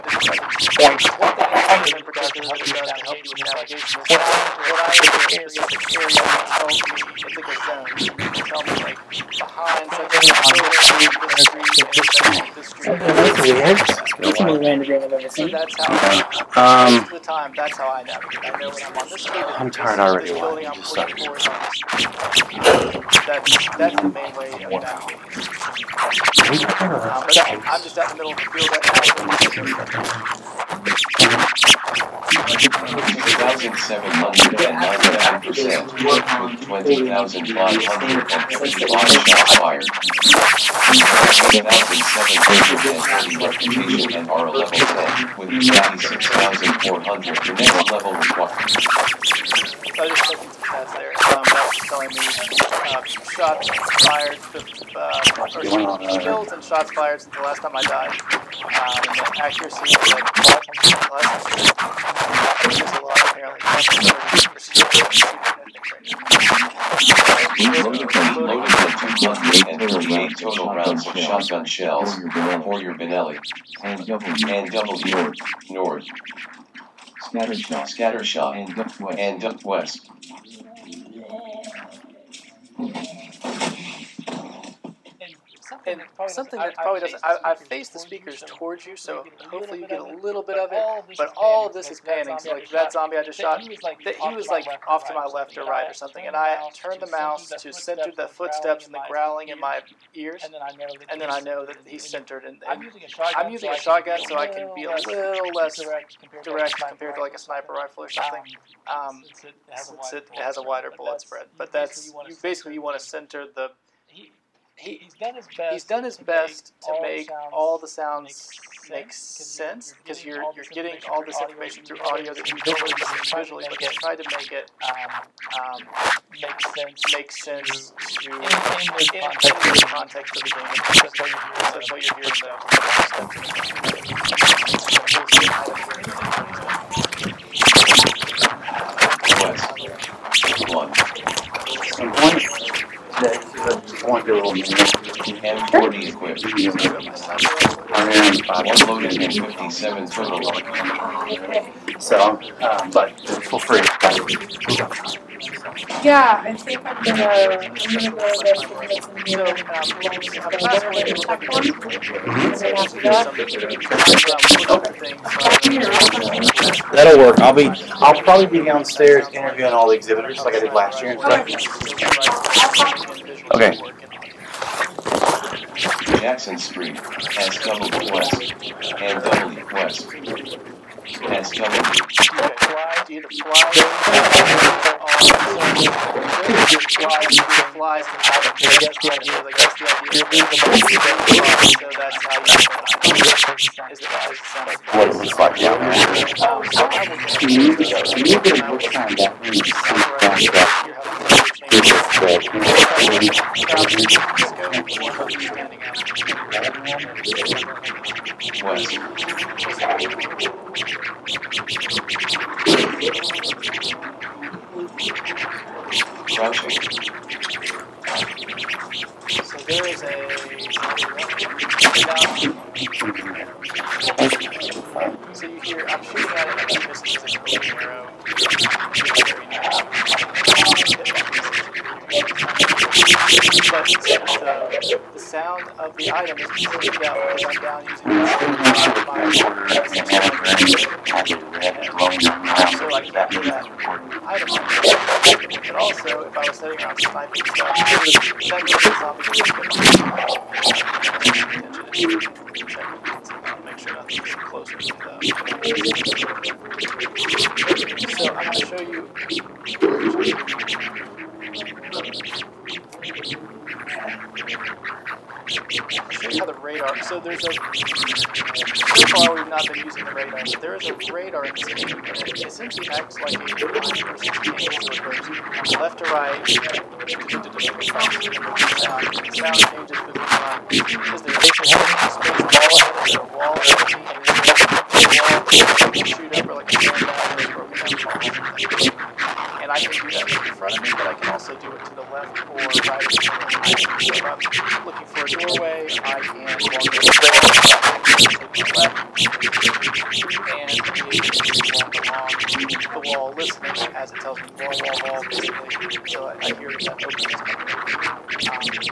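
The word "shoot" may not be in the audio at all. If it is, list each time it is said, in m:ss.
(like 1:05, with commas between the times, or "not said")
4:43.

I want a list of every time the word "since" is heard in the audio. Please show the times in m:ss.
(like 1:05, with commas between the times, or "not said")
0:57, 1:49.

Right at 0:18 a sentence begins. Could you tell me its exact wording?
I know when I'm on this I'm tired already.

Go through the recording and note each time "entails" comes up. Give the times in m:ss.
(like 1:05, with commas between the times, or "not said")
not said.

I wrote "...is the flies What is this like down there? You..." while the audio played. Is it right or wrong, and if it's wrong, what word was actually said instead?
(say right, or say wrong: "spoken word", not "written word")
right.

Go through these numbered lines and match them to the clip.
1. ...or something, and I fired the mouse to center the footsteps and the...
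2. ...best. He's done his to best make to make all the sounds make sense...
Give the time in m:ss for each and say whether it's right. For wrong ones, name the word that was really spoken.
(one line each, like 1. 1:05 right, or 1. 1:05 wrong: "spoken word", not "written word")
1. 1:35 wrong: "turned", not "fired"
2. 1:55 right.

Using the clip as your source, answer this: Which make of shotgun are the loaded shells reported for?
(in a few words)
Benelli.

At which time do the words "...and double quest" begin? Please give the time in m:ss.
2:59.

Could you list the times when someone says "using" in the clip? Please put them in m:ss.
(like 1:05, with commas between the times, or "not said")
1:43, 3:57, 4:29.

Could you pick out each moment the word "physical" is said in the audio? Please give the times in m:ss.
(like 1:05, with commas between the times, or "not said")
not said.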